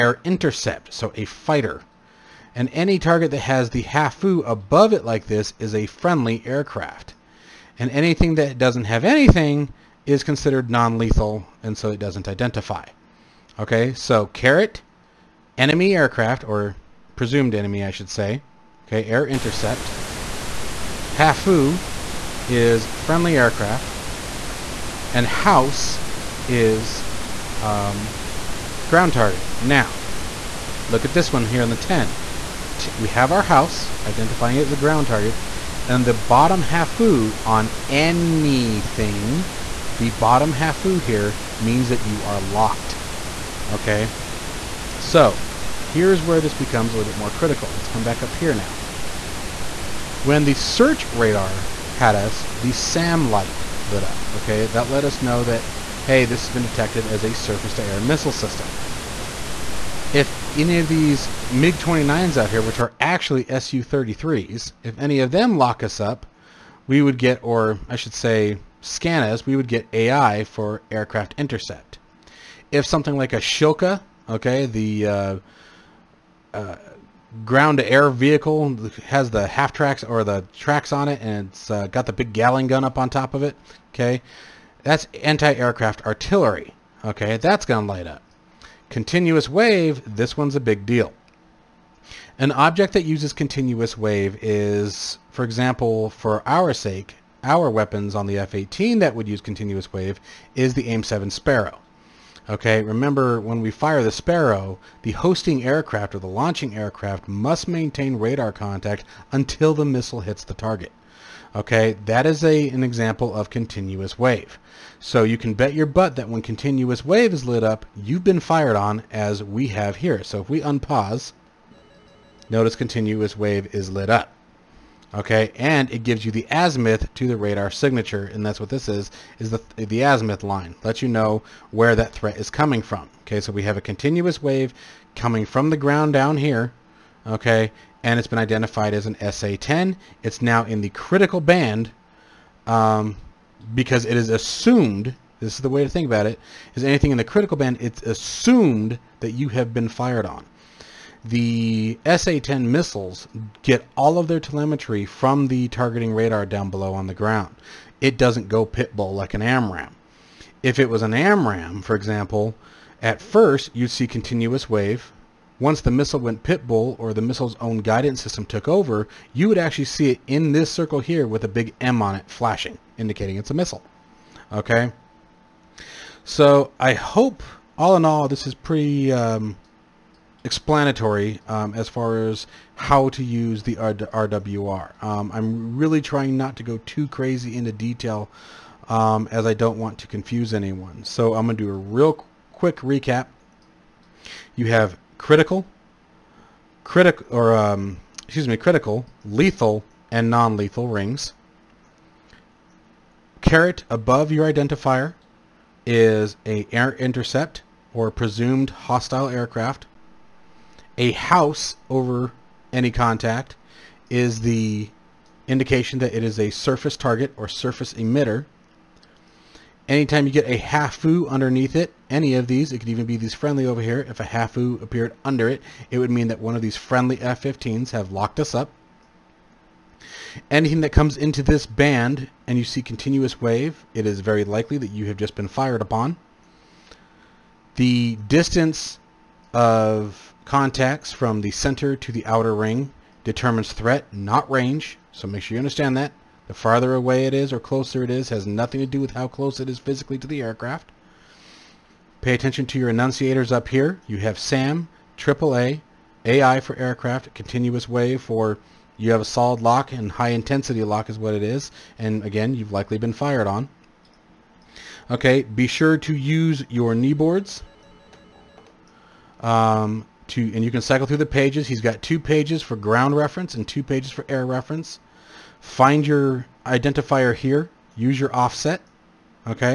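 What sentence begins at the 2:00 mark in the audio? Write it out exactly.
So if we unpause, notice continuous wave is lit up.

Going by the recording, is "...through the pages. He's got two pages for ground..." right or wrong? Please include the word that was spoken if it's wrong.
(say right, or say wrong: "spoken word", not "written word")
right.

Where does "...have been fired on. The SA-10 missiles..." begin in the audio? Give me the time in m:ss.
2:29.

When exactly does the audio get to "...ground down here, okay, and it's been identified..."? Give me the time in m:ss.
2:15.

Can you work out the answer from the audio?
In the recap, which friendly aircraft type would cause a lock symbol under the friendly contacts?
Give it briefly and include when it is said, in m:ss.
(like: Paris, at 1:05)
F-15s, at 3:47.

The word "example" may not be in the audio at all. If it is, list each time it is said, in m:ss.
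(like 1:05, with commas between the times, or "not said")
1:35, 1:52, 2:41.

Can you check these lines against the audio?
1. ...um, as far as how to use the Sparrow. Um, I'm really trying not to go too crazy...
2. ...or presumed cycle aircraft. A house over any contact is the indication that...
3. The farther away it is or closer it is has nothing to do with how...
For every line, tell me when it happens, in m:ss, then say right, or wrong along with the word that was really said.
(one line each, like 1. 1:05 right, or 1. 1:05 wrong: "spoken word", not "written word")
1. 3:01 wrong: "RWR", not "Sparrow"
2. 3:27 wrong: "hostile", not "cycle"
3. 4:06 right.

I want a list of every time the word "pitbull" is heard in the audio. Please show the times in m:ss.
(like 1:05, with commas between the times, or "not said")
2:38, 2:46.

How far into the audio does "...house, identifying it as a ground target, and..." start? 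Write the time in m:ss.
0:33.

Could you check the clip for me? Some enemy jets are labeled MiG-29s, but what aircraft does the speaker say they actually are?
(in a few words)
Su-33s.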